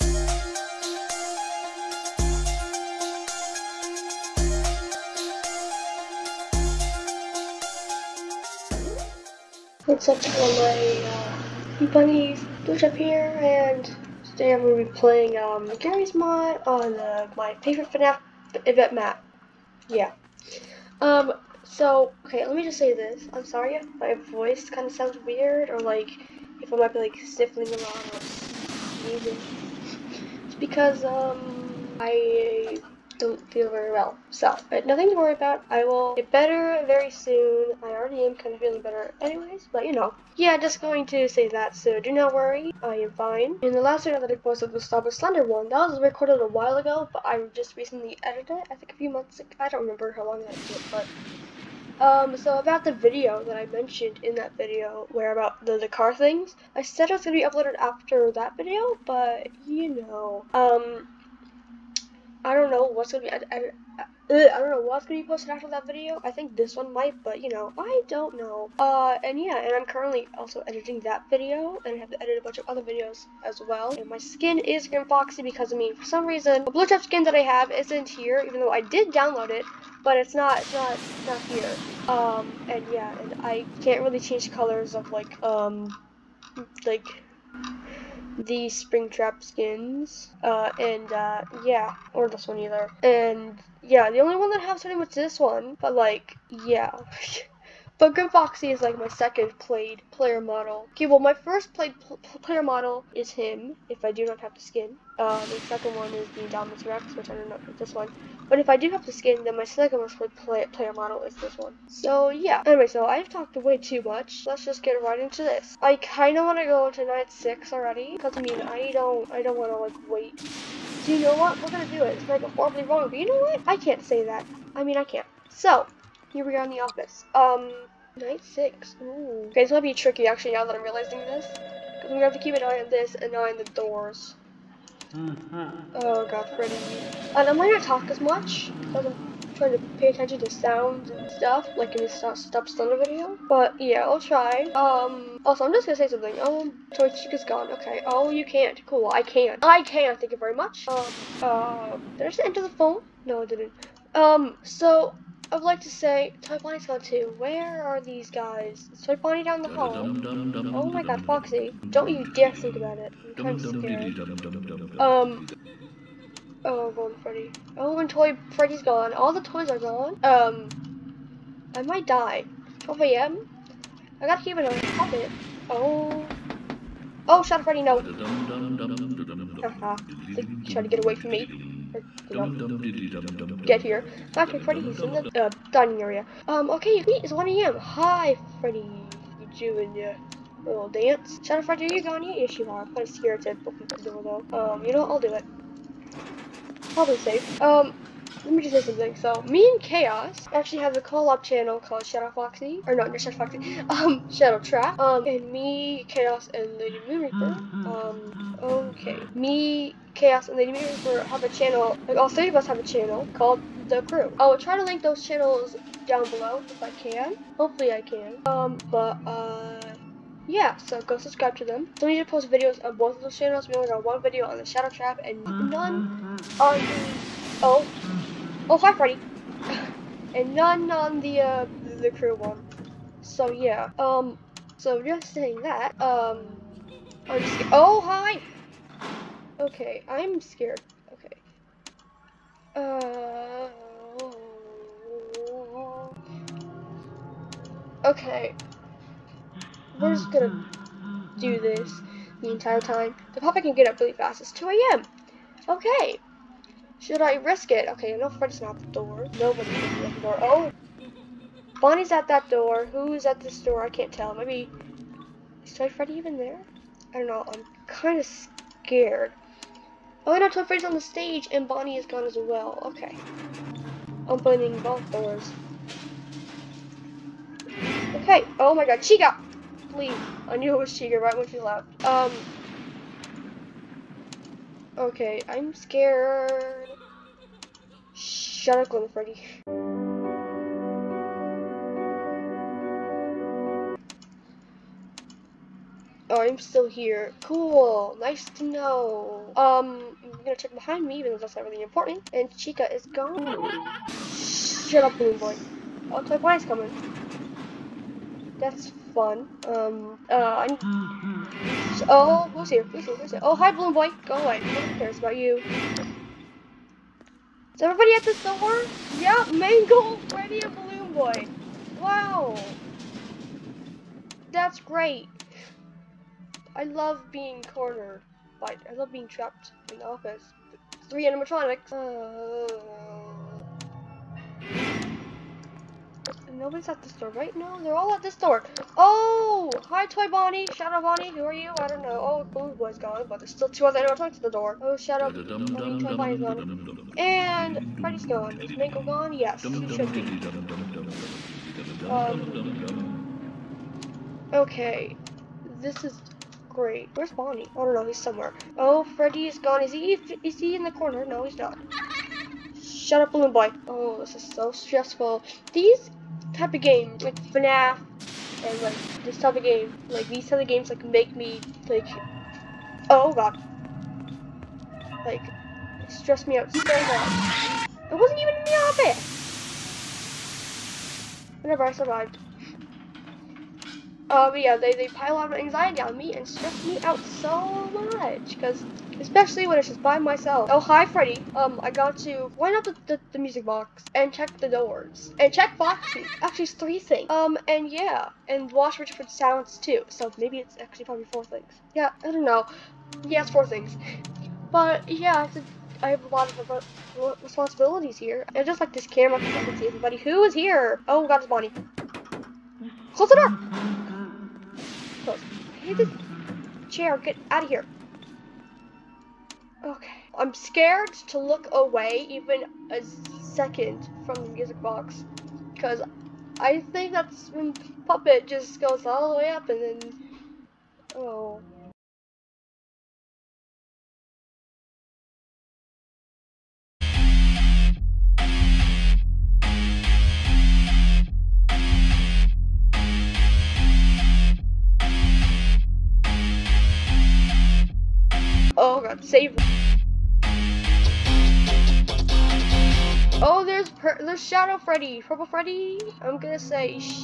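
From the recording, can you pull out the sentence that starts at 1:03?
I, I don't know what's gonna be posted after that video.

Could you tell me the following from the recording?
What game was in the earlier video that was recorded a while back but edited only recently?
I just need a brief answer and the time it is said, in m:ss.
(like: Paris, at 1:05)
Stop It Slender, at 0:44.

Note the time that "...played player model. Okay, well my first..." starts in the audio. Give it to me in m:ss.
1:39.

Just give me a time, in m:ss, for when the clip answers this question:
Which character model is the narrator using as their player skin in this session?
1:14.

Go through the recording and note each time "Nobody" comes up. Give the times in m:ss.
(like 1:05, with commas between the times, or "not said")
4:19, 5:36.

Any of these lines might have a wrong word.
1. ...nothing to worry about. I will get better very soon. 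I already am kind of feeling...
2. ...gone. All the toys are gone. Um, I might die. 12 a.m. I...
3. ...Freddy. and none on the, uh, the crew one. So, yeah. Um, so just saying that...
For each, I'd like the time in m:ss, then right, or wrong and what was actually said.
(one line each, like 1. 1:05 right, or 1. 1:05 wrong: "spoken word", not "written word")
1. 0:34 right
2. 2:48 right
3. 3:48 right.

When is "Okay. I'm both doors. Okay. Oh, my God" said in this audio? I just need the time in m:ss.
4:32.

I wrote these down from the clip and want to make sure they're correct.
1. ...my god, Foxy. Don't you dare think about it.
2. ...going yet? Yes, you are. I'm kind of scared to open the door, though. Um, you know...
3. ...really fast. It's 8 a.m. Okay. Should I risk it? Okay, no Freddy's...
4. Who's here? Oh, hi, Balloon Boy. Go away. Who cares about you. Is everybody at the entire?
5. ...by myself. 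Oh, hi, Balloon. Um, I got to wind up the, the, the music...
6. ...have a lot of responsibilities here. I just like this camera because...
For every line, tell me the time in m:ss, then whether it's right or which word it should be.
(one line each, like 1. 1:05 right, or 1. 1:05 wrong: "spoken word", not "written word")
1. 2:40 right
2. 3:12 right
3. 4:13 wrong: "2", not "8"
4. 5:13 wrong: "store", not "entire"
5. 6:30 wrong: "Freddy", not "Balloon"
6. 6:46 right.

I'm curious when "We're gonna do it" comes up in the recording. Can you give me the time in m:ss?
2:01.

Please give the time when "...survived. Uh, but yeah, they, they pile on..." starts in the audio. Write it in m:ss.
6:21.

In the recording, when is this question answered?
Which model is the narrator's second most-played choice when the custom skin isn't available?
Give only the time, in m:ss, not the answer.
1:46.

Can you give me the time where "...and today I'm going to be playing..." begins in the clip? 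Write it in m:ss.
0:13.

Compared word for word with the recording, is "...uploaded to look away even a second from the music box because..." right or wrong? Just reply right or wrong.
wrong.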